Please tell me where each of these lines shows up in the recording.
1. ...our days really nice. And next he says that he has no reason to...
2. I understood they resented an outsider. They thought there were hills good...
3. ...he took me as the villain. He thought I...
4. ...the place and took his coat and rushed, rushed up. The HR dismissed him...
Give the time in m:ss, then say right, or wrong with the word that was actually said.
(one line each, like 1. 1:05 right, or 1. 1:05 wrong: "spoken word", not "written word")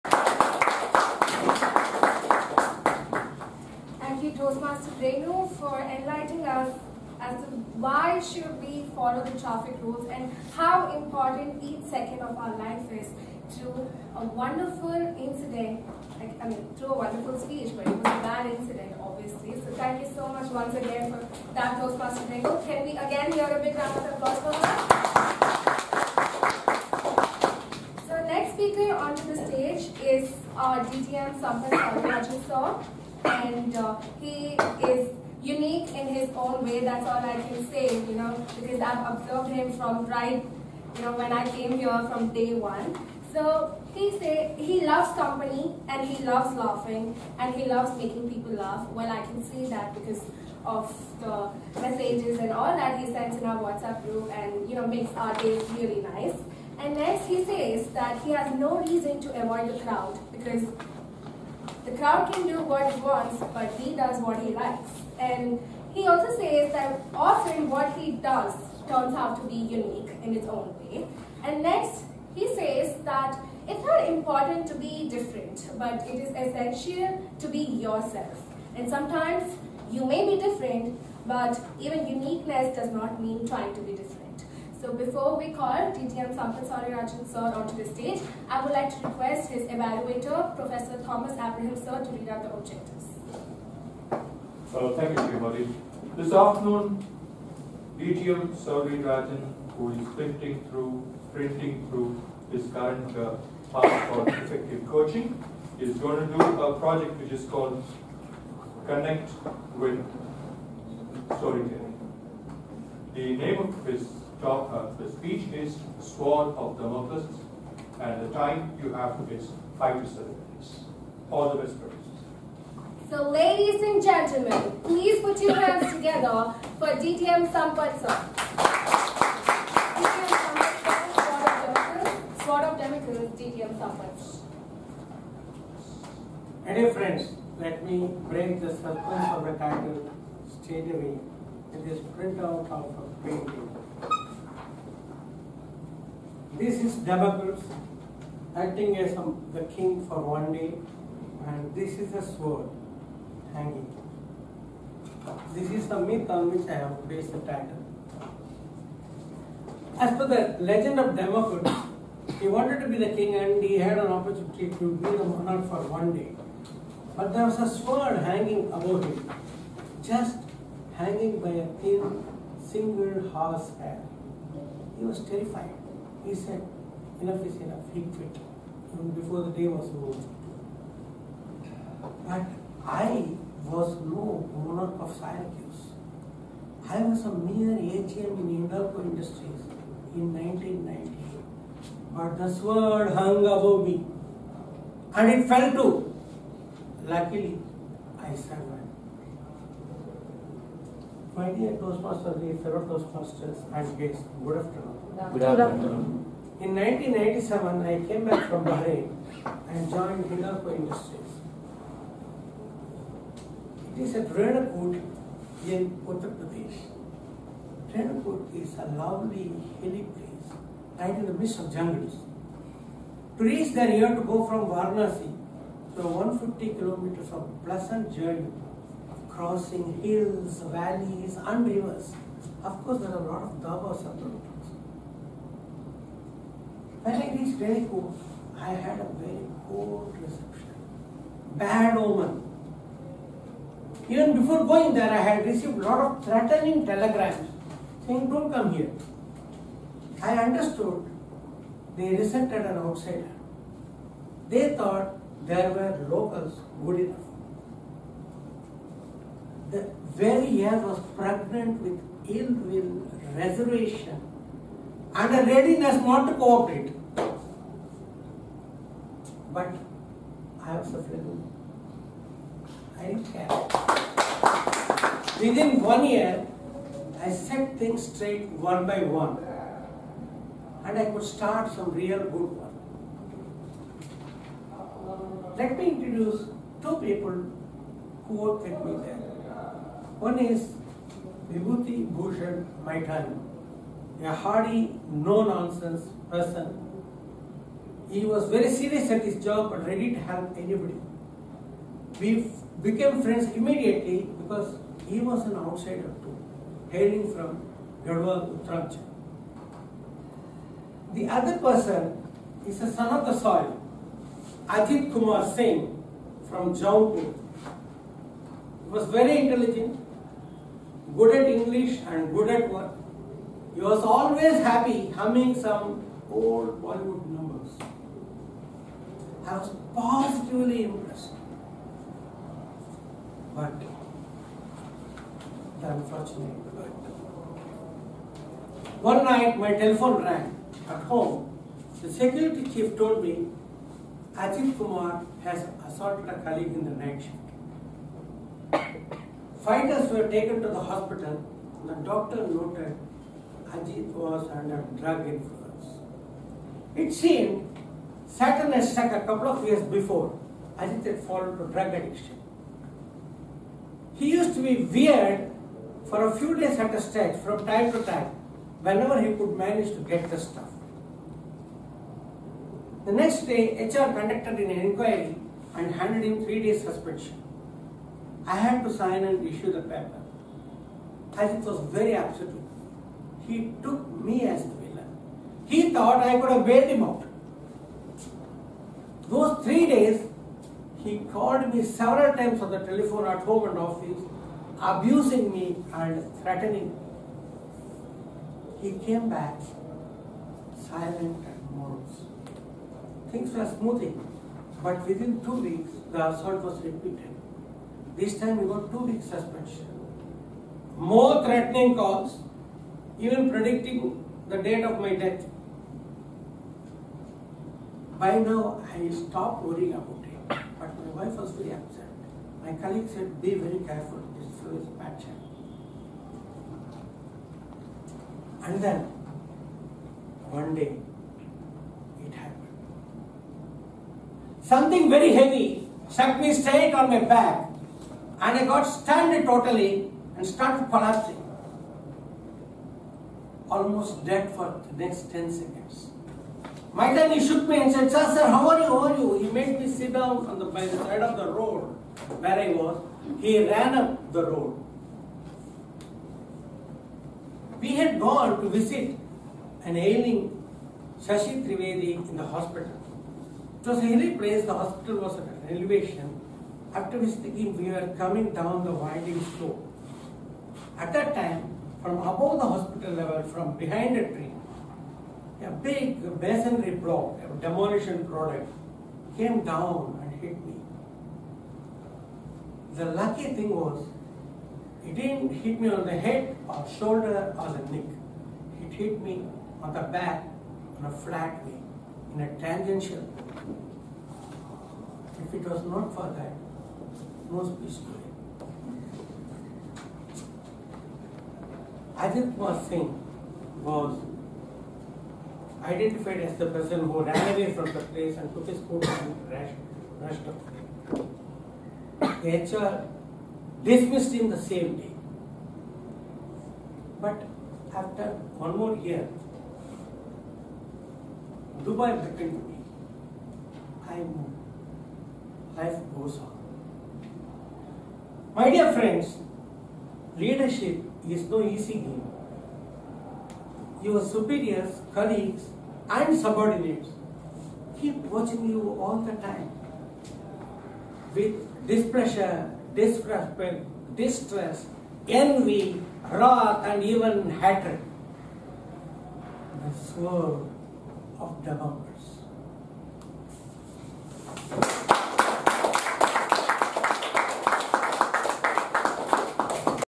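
1. 0:55 right
2. 4:10 wrong: "locals", not "hills"
3. 6:23 right
4. 8:27 right.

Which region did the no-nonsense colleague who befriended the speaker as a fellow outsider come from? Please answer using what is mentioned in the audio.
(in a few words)
Garhwal.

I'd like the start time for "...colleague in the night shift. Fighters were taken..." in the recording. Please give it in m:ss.
5:46.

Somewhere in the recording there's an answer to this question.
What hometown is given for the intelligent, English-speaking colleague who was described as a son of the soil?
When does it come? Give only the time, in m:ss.
5:16.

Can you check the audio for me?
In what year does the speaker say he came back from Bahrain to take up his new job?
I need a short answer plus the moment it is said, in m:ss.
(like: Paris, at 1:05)
1997, at 3:26.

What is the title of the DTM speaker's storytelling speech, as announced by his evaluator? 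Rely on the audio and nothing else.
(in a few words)
The Sword of Damocles.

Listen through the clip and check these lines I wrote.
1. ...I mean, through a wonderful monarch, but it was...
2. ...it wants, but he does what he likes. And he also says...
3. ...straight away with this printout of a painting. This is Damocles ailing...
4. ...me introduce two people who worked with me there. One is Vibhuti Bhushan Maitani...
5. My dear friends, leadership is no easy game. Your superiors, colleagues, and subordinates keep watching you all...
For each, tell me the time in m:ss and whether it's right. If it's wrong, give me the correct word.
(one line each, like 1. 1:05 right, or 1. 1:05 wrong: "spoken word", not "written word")
1. 0:16 wrong: "speech", not "monarch"
2. 1:02 right
3. 2:20 wrong: "acting", not "ailing"
4. 4:45 right
5. 8:48 right.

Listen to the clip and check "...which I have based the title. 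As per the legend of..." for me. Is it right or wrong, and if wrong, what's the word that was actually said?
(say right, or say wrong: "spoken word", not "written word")
right.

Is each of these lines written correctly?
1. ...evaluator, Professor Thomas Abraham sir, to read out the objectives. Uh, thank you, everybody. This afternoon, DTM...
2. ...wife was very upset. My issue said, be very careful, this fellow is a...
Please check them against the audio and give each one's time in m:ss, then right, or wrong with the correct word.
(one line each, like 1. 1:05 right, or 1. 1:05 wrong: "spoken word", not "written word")
1. 1:29 right
2. 7:01 wrong: "colleague", not "issue".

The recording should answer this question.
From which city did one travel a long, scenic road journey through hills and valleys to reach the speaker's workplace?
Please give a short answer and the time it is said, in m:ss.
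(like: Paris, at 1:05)
Varanasi, at 3:44.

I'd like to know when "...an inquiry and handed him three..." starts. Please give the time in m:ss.
6:14.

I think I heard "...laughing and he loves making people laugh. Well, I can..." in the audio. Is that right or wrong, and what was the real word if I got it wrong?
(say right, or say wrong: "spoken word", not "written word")
right.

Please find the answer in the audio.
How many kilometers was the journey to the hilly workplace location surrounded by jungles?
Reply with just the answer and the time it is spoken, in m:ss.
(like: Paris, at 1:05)
150, at 3:46.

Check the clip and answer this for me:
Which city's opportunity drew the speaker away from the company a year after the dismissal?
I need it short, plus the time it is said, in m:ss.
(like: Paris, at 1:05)
Dubai, at 8:41.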